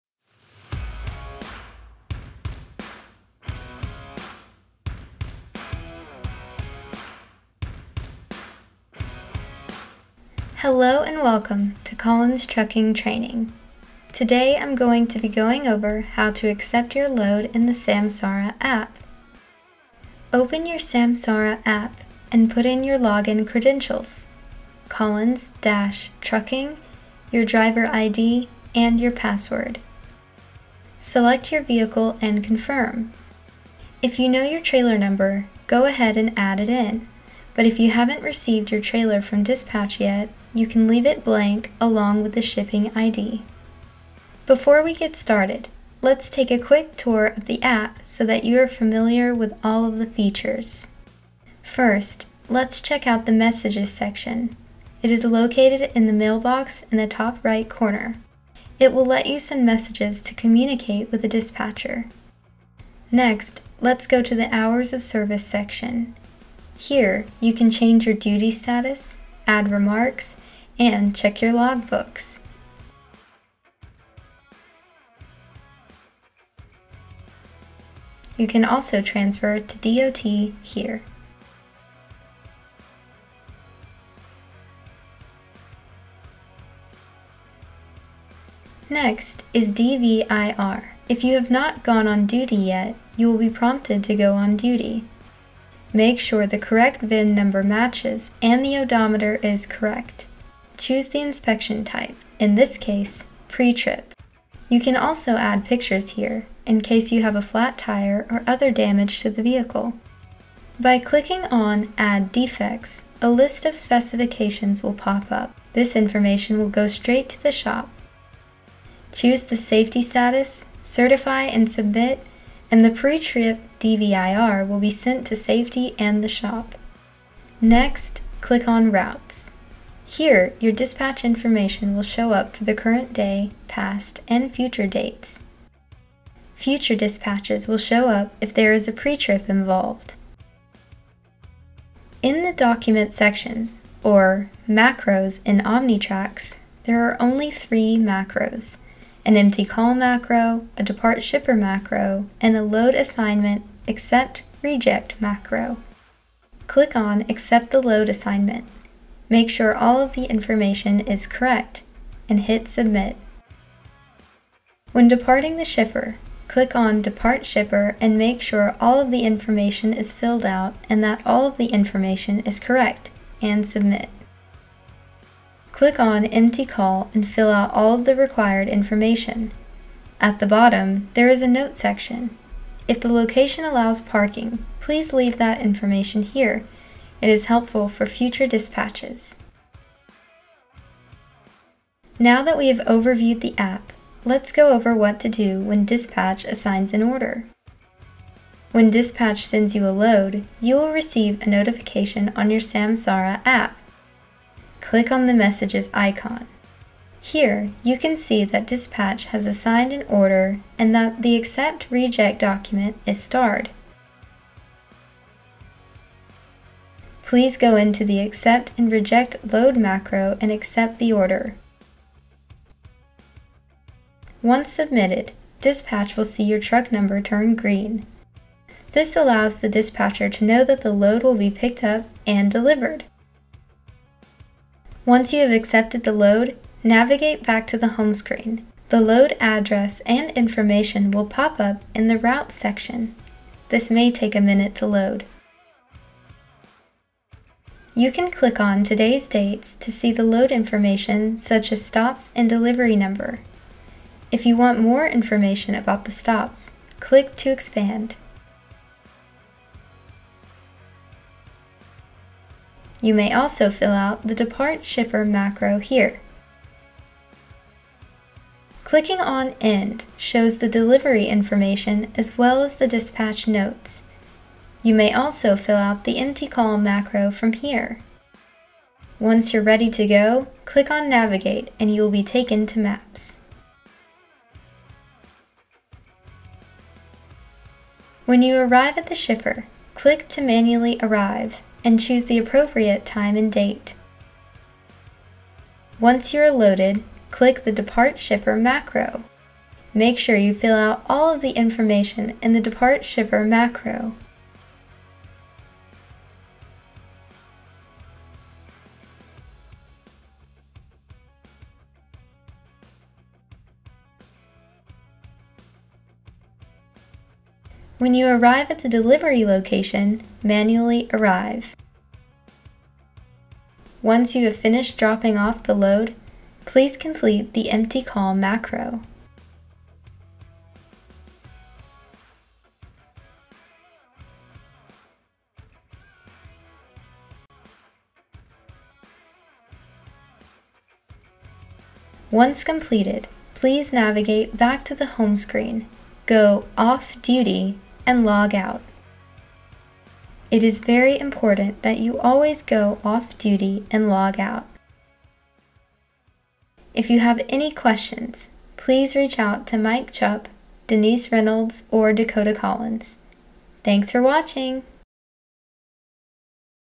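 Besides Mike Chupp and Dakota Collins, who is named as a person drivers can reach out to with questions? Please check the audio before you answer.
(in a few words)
Denise Reynolds.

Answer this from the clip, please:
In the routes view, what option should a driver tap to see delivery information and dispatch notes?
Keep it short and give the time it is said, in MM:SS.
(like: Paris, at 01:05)
End, at 04:29.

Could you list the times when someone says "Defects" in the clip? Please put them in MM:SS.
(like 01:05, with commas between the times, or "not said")
01:52.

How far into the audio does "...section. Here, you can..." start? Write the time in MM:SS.
01:05.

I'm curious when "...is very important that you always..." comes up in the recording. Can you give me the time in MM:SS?
05:50.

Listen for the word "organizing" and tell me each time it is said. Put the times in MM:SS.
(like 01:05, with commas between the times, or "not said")
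not said.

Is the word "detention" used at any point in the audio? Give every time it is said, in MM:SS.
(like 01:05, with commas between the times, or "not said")
not said.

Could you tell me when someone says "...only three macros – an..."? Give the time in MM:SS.
02:27.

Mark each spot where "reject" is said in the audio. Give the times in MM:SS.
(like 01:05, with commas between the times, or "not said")
02:34, 03:31, 03:38.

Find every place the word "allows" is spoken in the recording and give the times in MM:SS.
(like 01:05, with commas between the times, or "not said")
03:03, 03:49.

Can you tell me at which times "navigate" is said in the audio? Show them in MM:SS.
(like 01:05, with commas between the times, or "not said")
03:56, 04:41, 05:43.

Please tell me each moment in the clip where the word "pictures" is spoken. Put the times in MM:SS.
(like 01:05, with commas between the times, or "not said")
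01:45.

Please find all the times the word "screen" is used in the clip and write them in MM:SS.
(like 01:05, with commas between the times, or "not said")
03:58, 05:45.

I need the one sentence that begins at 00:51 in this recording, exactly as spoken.
First, let's check out the Messages section.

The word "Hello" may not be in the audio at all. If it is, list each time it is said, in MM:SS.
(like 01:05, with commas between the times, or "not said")
00:10.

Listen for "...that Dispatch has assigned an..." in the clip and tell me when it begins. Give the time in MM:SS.
03:28.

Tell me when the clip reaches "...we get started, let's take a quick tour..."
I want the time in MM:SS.
00:44.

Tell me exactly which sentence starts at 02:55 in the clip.
Click on Empty Call and fill out all of the required information.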